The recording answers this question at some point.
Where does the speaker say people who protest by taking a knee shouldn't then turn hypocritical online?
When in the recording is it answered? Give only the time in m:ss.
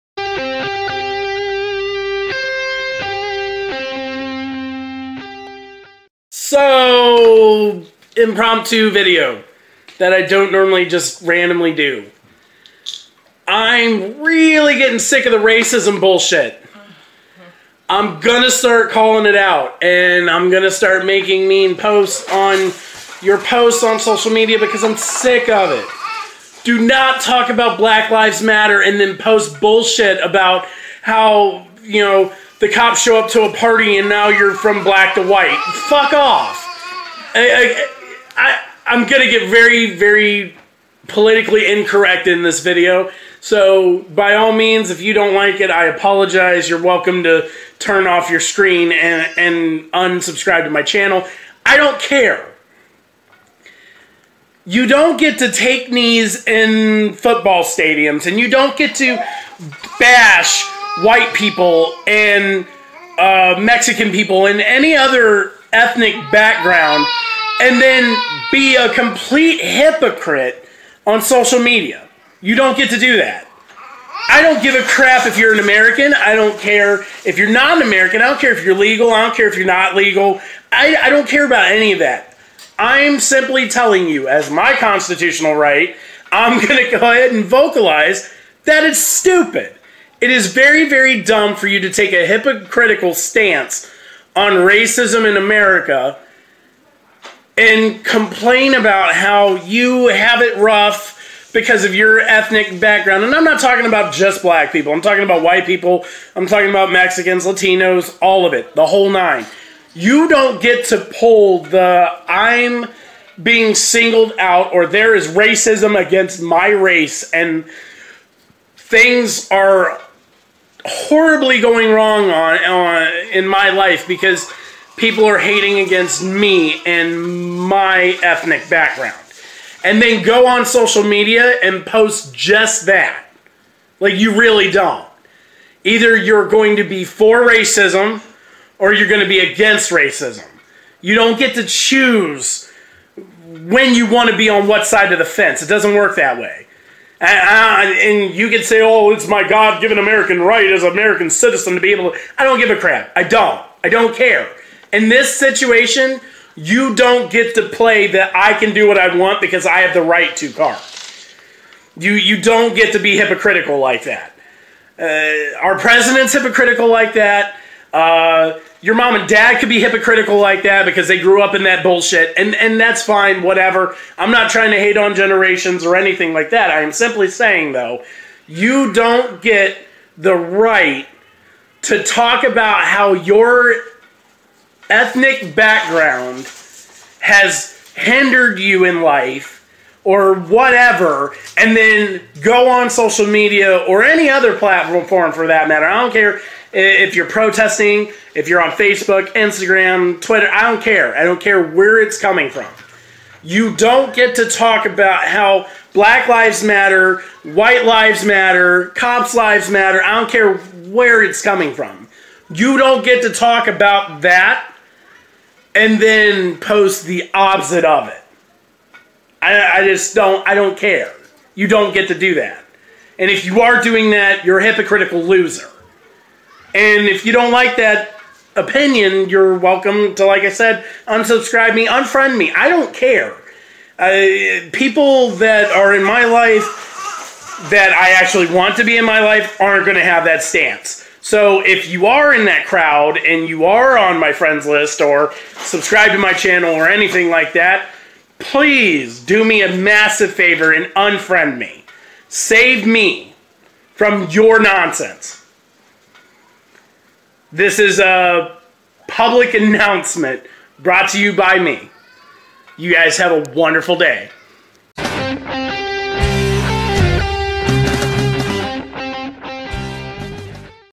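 0:57.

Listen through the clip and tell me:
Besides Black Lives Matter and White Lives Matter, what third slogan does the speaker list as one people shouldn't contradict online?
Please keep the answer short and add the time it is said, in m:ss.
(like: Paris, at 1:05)
Cops Lives Matter, at 3:28.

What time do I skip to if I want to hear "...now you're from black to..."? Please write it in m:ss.
0:34.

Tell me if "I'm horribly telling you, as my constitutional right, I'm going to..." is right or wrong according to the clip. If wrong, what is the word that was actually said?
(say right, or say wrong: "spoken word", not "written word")
wrong: "simply", not "horribly".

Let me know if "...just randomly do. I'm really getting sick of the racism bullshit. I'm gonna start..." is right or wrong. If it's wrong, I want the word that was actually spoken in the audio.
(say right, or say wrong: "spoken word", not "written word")
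right.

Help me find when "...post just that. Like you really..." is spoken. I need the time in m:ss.
2:11.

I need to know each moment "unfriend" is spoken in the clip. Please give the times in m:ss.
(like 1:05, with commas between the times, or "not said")
3:51, 4:10.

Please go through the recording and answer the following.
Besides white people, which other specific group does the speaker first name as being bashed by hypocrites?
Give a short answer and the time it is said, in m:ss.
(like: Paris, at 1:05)
Mexican people, at 1:03.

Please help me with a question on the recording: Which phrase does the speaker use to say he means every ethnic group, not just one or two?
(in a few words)
The whole nine.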